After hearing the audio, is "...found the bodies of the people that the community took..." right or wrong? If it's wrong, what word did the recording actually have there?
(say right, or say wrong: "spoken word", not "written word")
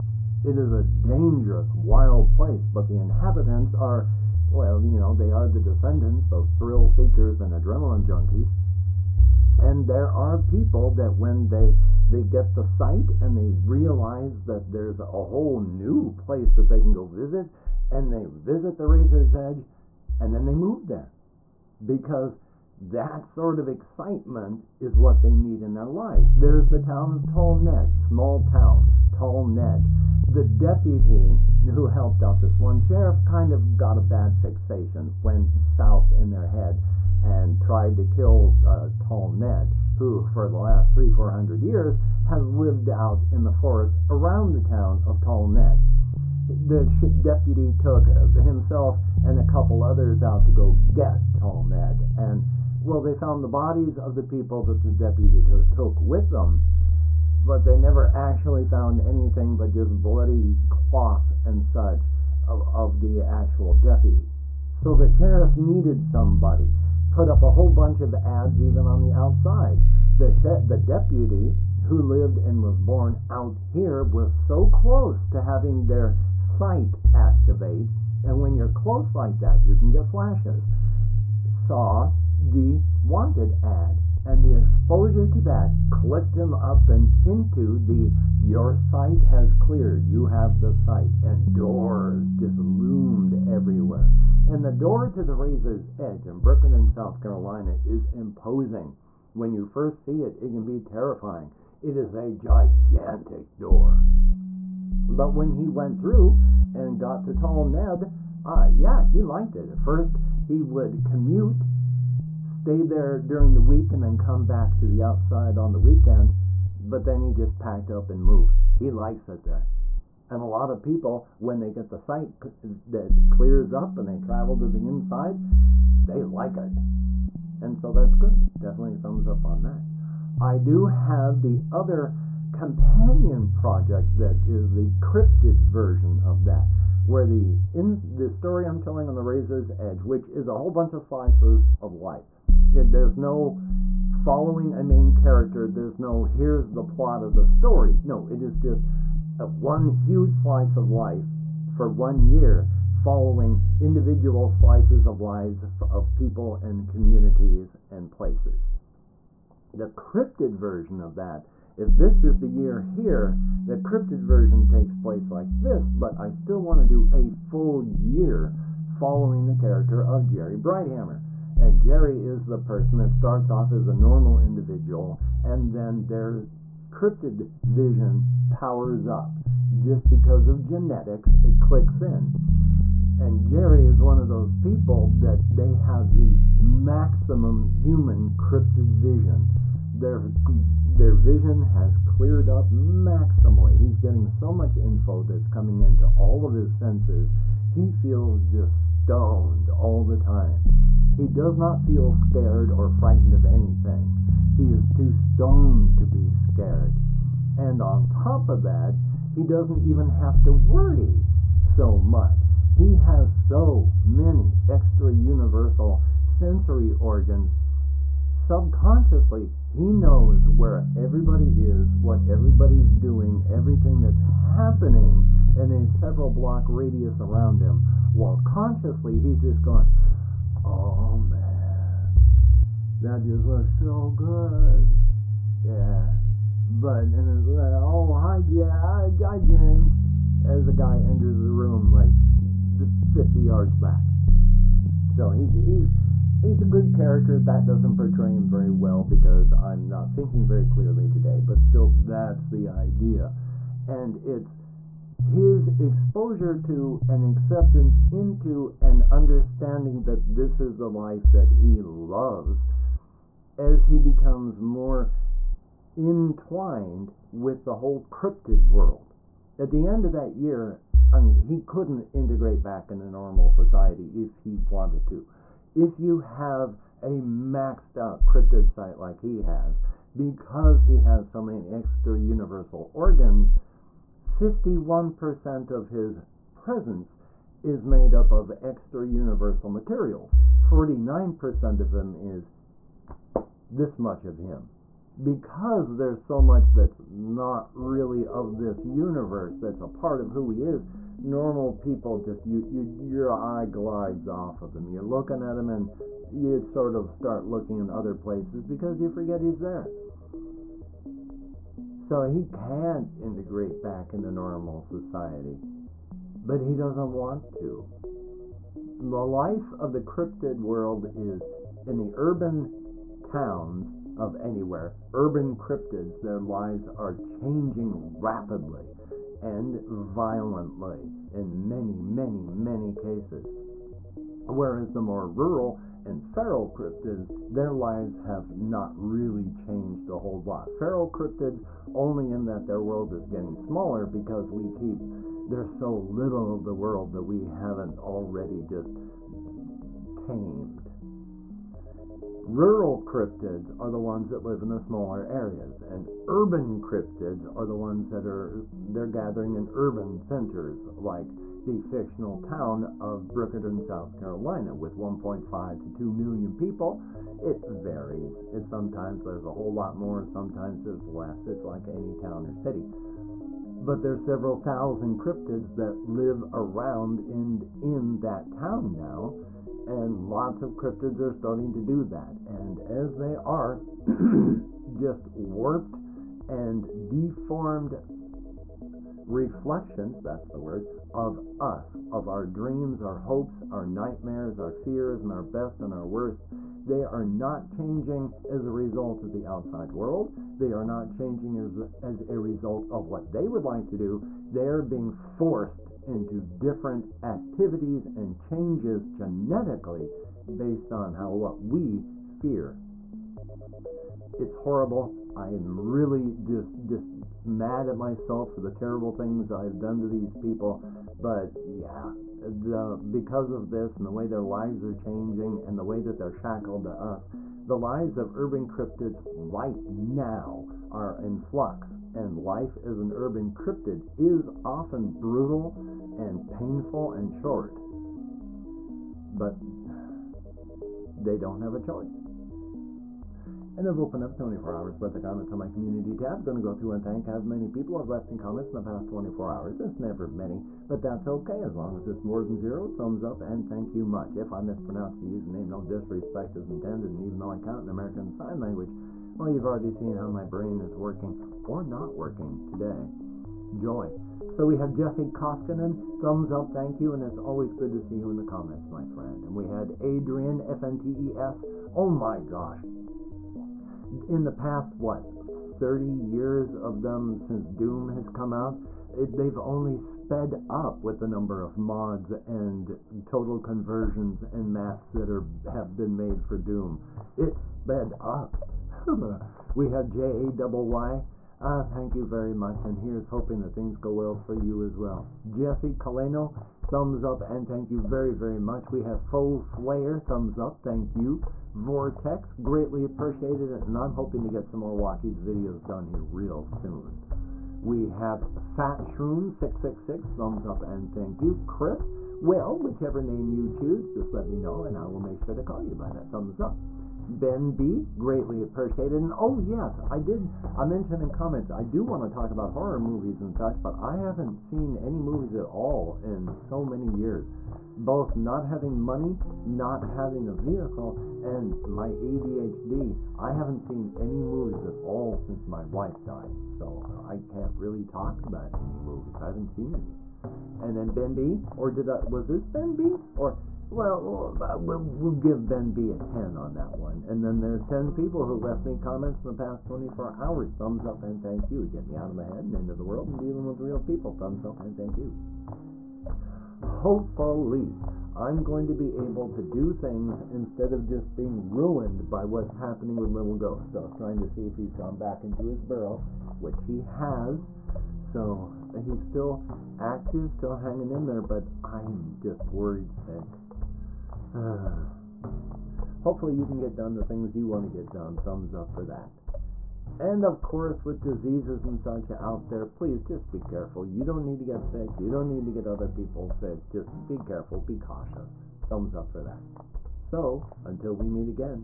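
wrong: "deputy", not "community".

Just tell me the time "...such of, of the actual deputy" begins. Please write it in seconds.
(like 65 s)
61 s.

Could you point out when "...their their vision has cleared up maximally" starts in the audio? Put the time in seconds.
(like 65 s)
190 s.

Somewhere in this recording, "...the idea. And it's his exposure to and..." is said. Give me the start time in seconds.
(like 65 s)
252 s.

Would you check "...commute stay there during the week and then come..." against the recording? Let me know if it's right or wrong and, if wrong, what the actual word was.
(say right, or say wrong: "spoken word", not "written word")
right.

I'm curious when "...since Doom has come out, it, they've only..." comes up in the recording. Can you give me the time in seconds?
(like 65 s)
477 s.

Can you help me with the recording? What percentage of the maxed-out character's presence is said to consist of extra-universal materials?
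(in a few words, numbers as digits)
51%.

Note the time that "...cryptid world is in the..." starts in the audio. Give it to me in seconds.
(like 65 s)
320 s.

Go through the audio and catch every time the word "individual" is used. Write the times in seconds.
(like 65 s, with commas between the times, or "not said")
153 s, 174 s.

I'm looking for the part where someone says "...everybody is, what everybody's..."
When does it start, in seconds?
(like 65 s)
220 s.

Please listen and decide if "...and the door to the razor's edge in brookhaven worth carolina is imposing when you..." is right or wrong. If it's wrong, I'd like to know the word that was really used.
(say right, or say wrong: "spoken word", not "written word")
wrong: "south", not "worth".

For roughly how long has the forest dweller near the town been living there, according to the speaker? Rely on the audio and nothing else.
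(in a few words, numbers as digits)
300 to 400 years.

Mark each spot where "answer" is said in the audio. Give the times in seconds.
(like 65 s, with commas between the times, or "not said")
not said.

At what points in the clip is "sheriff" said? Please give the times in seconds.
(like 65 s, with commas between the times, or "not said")
32 s, 65 s.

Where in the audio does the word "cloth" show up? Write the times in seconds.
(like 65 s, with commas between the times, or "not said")
60 s.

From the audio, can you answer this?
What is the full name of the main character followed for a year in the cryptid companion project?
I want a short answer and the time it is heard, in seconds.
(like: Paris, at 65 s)
Jerry Brighthammer, at 170 s.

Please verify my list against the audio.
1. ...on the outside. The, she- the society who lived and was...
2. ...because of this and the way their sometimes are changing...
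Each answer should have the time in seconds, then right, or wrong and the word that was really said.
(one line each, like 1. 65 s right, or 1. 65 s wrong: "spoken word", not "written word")
1. 68 s wrong: "deputy", not "society"
2. 423 s wrong: "lives", not "sometimes".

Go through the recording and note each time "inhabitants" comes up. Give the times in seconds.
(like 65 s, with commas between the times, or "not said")
2 s.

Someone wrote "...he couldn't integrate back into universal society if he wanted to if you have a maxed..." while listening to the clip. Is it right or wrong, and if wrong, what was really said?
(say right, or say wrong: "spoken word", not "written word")
wrong: "normal", not "universal".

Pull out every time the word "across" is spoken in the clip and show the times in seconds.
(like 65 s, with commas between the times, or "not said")
not said.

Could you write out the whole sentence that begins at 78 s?
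And when you're close like that, you can get flashes.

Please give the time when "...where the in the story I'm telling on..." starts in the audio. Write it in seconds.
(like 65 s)
137 s.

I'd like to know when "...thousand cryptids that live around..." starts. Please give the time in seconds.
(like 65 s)
374 s.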